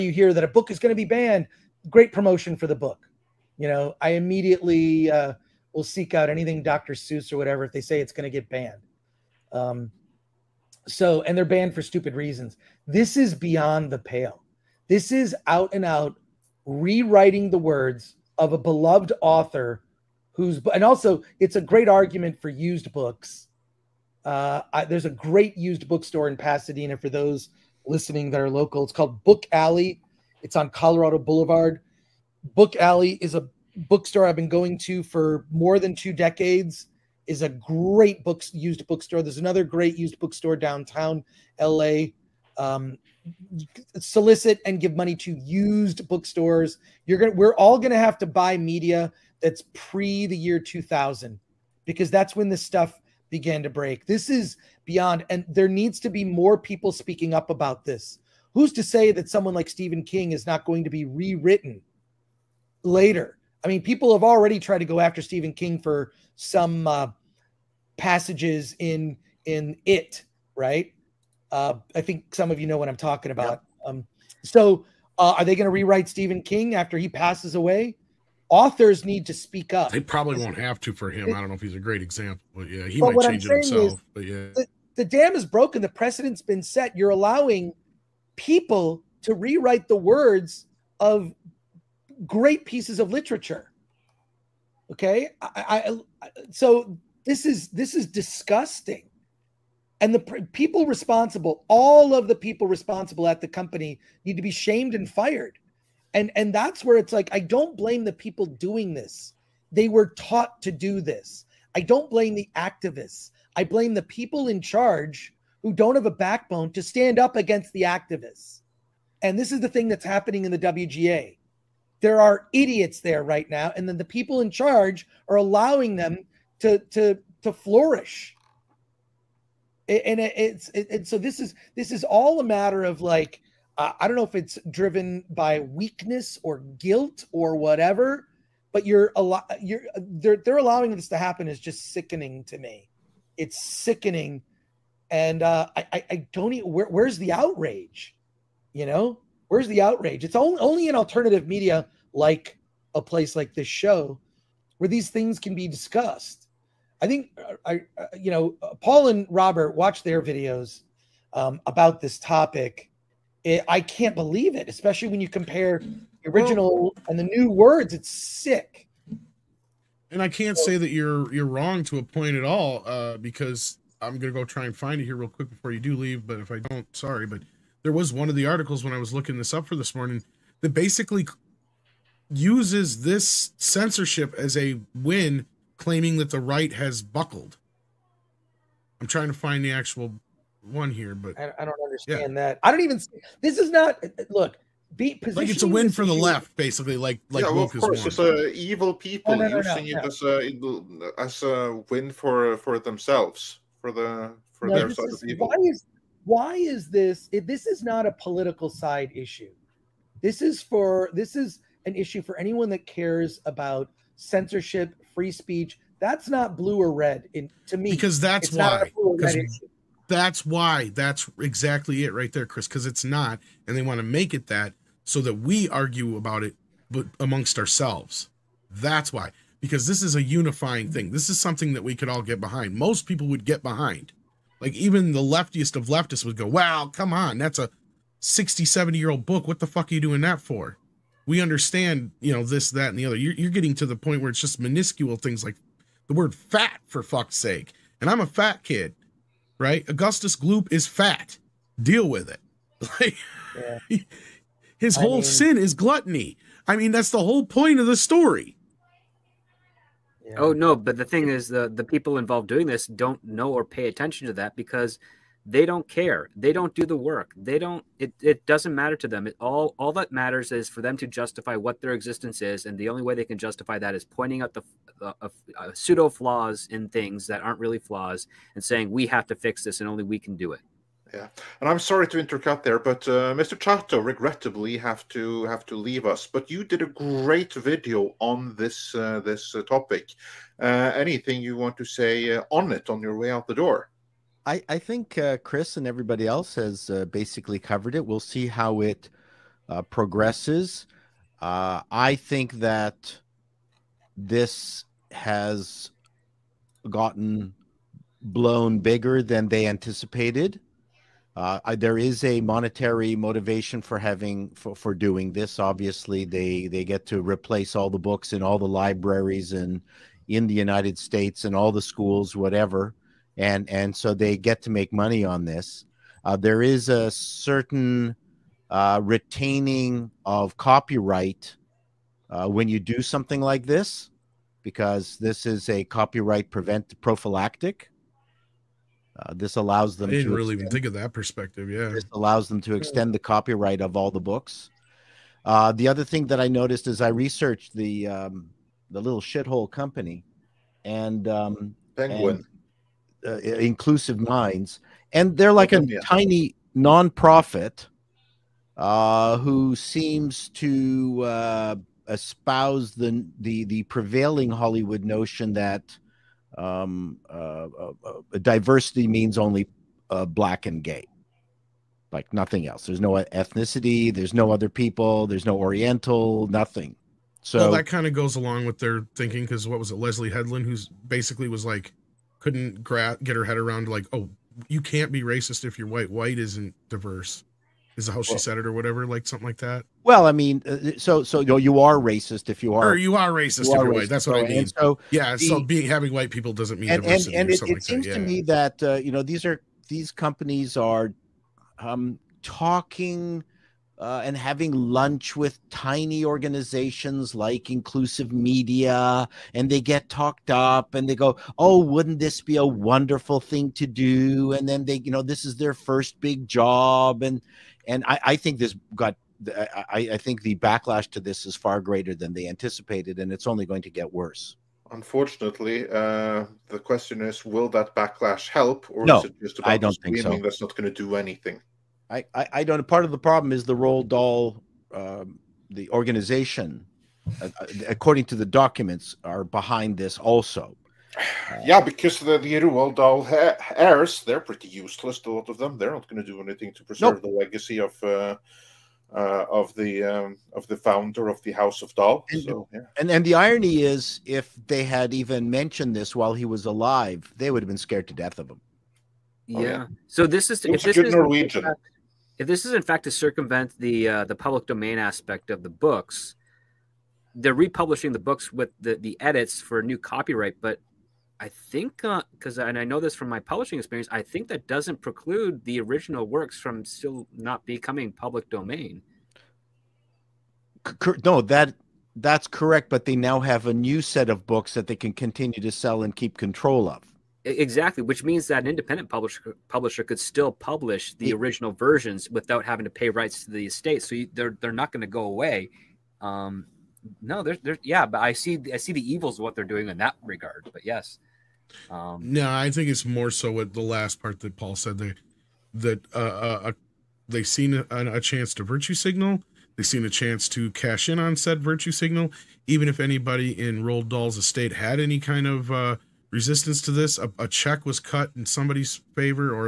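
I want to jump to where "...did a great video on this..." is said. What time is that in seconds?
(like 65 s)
286 s.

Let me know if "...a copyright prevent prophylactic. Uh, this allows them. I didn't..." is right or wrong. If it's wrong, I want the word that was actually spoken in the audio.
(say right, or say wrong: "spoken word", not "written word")
right.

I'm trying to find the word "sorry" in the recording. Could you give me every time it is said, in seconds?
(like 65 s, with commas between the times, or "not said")
176 s, 281 s.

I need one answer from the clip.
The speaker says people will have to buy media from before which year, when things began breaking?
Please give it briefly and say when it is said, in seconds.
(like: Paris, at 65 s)
2000, at 50 s.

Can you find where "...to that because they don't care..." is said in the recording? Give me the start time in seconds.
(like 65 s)
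264 s.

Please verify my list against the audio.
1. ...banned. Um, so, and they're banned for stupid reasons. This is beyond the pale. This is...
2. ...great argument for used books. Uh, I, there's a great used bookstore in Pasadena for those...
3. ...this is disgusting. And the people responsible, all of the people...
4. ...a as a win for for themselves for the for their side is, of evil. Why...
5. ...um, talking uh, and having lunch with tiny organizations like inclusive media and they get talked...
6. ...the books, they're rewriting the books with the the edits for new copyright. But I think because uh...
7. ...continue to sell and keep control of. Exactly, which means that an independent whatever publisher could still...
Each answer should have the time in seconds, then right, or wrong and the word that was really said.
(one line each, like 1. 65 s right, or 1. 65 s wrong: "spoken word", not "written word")
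1. 8 s right
2. 21 s right
3. 97 s right
4. 200 s right
5. 401 s right
6. 465 s wrong: "republishing", not "rewriting"
7. 485 s wrong: "publisher", not "whatever".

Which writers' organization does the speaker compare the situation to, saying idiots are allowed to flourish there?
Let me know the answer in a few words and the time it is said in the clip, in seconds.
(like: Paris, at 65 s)
WGA, at 120 s.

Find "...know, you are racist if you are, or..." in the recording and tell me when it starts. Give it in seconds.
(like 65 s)
391 s.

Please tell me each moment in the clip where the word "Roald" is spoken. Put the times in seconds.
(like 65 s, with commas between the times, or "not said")
433 s, 442 s, 513 s.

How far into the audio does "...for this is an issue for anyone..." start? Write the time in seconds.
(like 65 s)
210 s.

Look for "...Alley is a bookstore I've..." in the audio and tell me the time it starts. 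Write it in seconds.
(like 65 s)
32 s.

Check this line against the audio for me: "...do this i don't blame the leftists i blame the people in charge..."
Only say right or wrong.
wrong.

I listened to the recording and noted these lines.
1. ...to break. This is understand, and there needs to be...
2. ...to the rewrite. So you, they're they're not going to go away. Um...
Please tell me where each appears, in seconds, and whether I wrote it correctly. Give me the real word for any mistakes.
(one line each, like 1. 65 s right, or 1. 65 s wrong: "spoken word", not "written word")
1. 53 s wrong: "beyond", not "understand"
2. 493 s wrong: "estate", not "rewrite".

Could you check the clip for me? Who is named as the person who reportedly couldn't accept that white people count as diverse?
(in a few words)
Leslie Headland.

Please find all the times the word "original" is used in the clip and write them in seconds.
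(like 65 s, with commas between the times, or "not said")
166 s, 475 s, 491 s.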